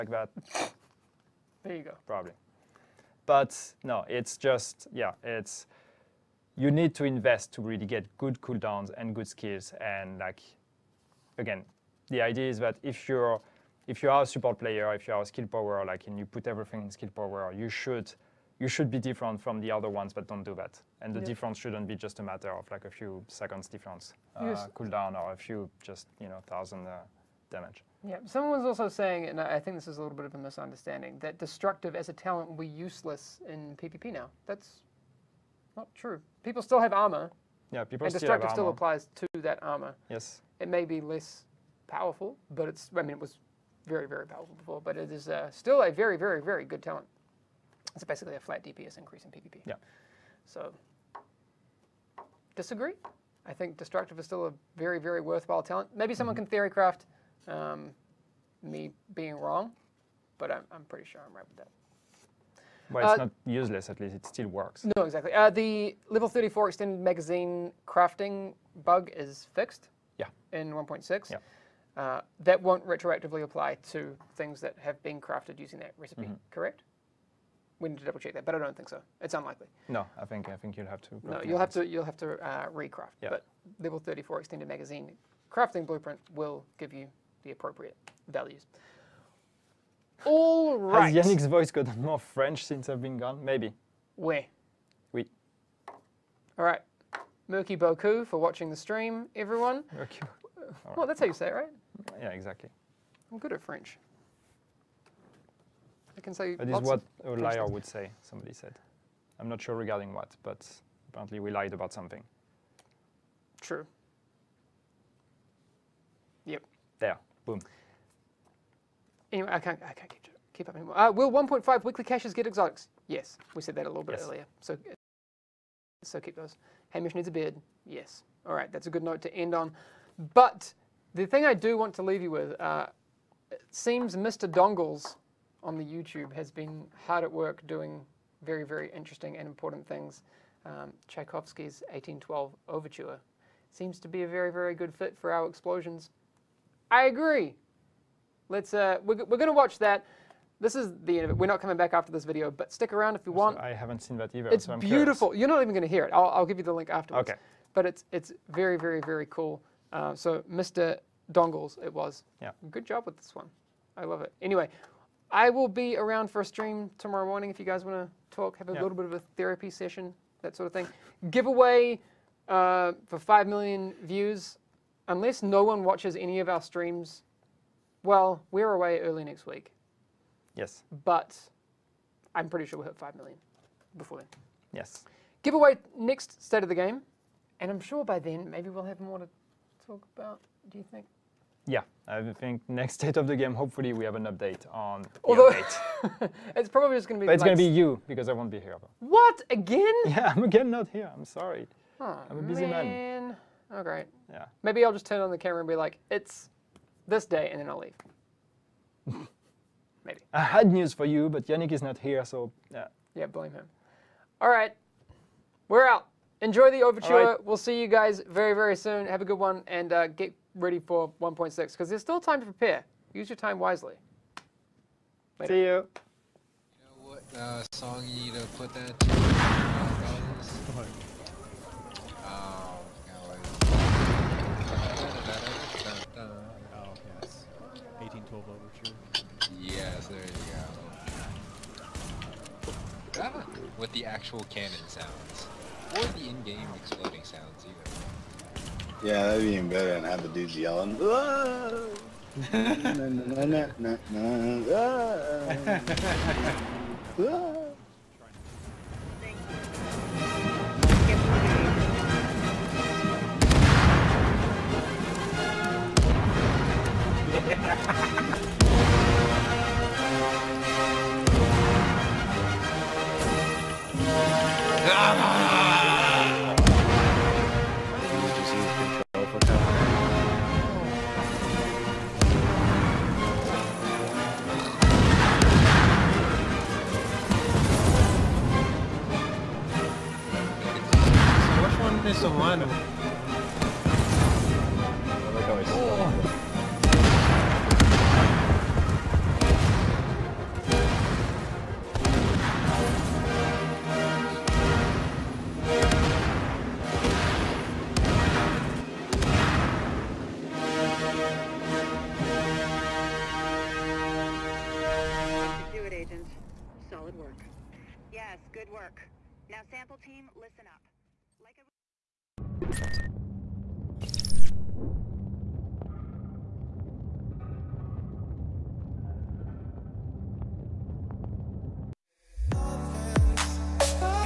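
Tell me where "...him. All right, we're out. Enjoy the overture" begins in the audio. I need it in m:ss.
3:33.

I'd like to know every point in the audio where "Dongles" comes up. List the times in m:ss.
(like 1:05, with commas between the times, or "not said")
2:14, 2:41.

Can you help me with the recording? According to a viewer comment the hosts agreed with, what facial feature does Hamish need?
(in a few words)
A beard.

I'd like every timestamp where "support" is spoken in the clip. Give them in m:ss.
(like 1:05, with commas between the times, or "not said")
0:14.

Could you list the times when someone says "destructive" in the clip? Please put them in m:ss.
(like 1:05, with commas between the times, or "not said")
0:31, 0:38, 0:53.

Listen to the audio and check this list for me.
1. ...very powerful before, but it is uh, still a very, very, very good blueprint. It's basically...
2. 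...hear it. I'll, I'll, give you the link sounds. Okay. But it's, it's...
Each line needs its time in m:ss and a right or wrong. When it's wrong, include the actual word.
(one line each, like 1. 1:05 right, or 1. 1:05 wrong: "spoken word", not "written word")
1. 0:44 wrong: "talent", not "blueprint"
2. 2:35 wrong: "afterwards", not "sounds".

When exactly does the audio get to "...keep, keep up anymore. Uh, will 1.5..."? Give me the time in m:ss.
2:00.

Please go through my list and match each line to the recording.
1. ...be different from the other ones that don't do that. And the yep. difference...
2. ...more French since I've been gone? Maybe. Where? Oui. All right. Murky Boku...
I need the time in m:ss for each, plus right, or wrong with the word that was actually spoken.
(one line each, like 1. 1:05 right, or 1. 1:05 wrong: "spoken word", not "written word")
1. 0:18 right
2. 1:32 right.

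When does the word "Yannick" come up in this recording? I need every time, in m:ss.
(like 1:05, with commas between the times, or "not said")
1:31, 3:31.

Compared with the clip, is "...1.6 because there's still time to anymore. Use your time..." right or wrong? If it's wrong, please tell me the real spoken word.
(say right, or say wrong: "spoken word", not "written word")
wrong: "prepare", not "anymore".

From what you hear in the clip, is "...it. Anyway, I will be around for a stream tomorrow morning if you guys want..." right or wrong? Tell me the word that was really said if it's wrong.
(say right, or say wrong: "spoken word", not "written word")
right.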